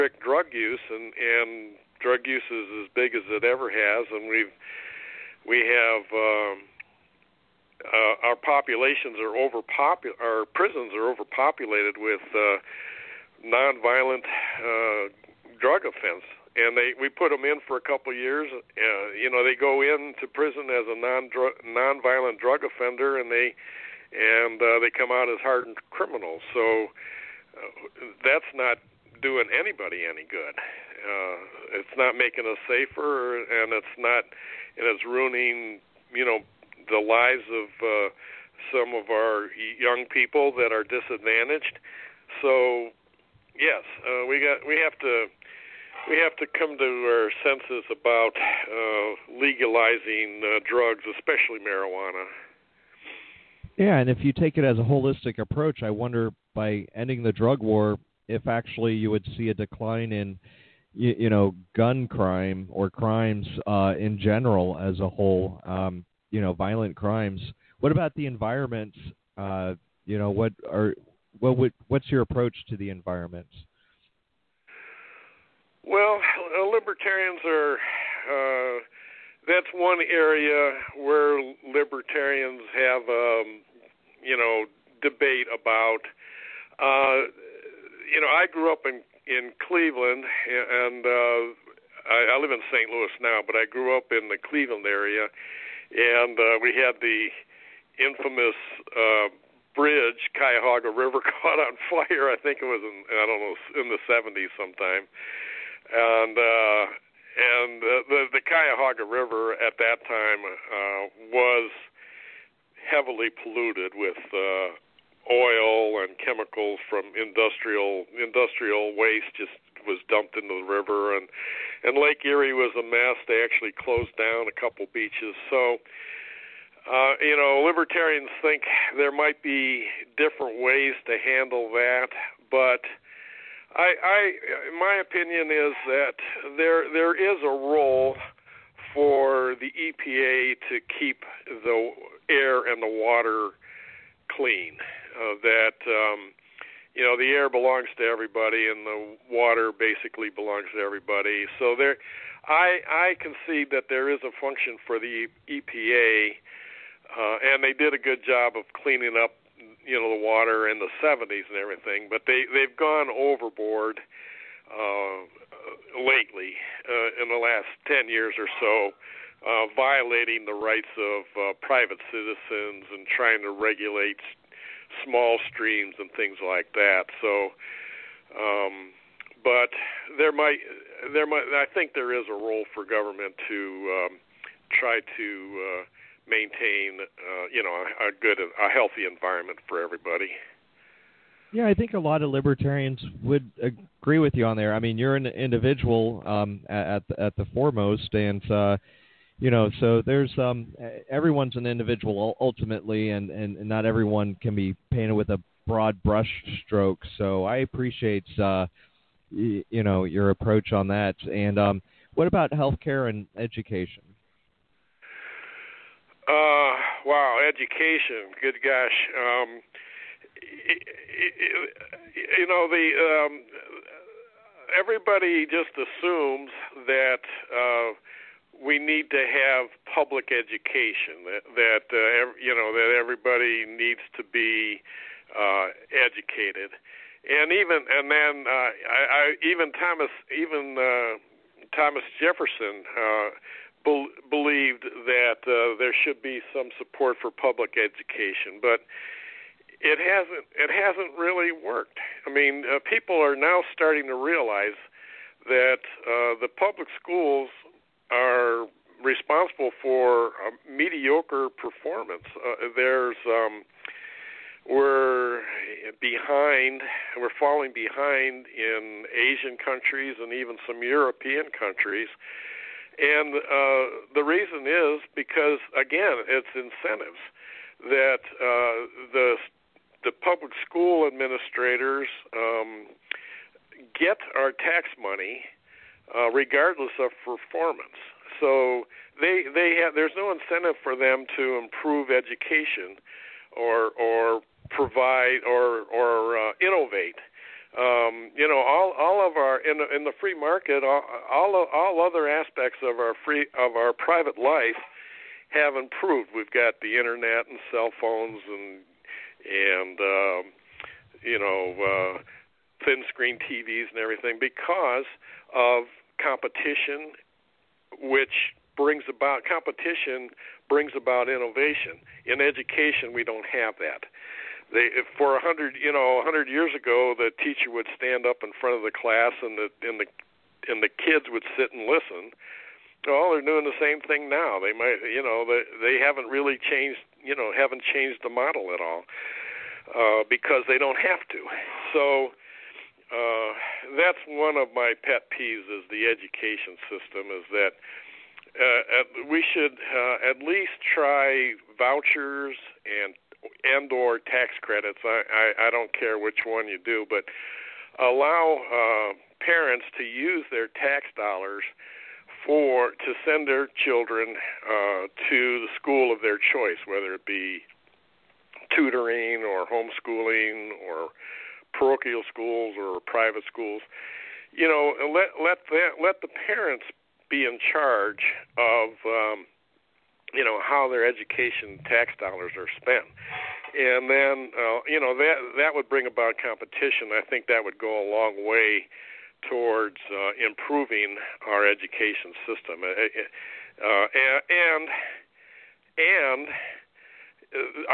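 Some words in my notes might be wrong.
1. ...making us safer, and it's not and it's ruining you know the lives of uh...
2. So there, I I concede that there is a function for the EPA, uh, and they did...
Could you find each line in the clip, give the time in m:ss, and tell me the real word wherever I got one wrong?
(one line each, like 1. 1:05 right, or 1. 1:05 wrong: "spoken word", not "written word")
1. 0:32 right
2. 2:31 right.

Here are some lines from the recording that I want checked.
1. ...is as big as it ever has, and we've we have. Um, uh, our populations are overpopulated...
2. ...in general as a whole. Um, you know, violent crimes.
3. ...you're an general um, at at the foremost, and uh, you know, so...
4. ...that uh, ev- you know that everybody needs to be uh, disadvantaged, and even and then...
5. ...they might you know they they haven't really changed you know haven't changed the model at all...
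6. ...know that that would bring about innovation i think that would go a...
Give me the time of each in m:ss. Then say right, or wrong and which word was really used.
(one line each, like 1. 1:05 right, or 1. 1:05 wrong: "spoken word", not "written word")
1. 0:02 right
2. 1:03 right
3. 3:14 wrong: "individual", not "general"
4. 3:51 wrong: "educated", not "disadvantaged"
5. 5:34 right
6. 6:24 wrong: "competition", not "innovation".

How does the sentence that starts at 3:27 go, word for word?
So I appreciate uh, you know your approach on that.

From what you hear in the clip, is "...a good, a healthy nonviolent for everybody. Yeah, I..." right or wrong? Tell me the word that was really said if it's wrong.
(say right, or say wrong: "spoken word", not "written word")
wrong: "environment", not "nonviolent".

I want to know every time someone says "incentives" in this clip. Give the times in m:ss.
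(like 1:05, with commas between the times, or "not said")
4:36, 4:50.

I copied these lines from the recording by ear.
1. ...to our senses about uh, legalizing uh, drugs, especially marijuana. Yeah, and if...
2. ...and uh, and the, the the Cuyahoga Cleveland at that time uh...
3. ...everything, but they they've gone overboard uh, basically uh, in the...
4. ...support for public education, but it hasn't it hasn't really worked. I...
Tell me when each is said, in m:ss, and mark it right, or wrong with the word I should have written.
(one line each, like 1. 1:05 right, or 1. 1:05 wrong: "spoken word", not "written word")
1. 0:46 right
2. 1:45 wrong: "River", not "Cleveland"
3. 2:41 wrong: "lately", not "basically"
4. 4:06 right.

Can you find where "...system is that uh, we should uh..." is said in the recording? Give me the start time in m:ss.
5:46.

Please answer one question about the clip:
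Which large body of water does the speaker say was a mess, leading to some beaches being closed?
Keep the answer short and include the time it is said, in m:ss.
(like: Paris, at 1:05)
Lake Erie, at 2:01.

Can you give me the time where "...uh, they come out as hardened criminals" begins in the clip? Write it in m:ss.
0:24.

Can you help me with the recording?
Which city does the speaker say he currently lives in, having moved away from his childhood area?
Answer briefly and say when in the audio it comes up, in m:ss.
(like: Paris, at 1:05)
St. Louis, at 1:32.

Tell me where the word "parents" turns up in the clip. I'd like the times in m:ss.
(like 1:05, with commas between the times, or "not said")
5:59, 6:16.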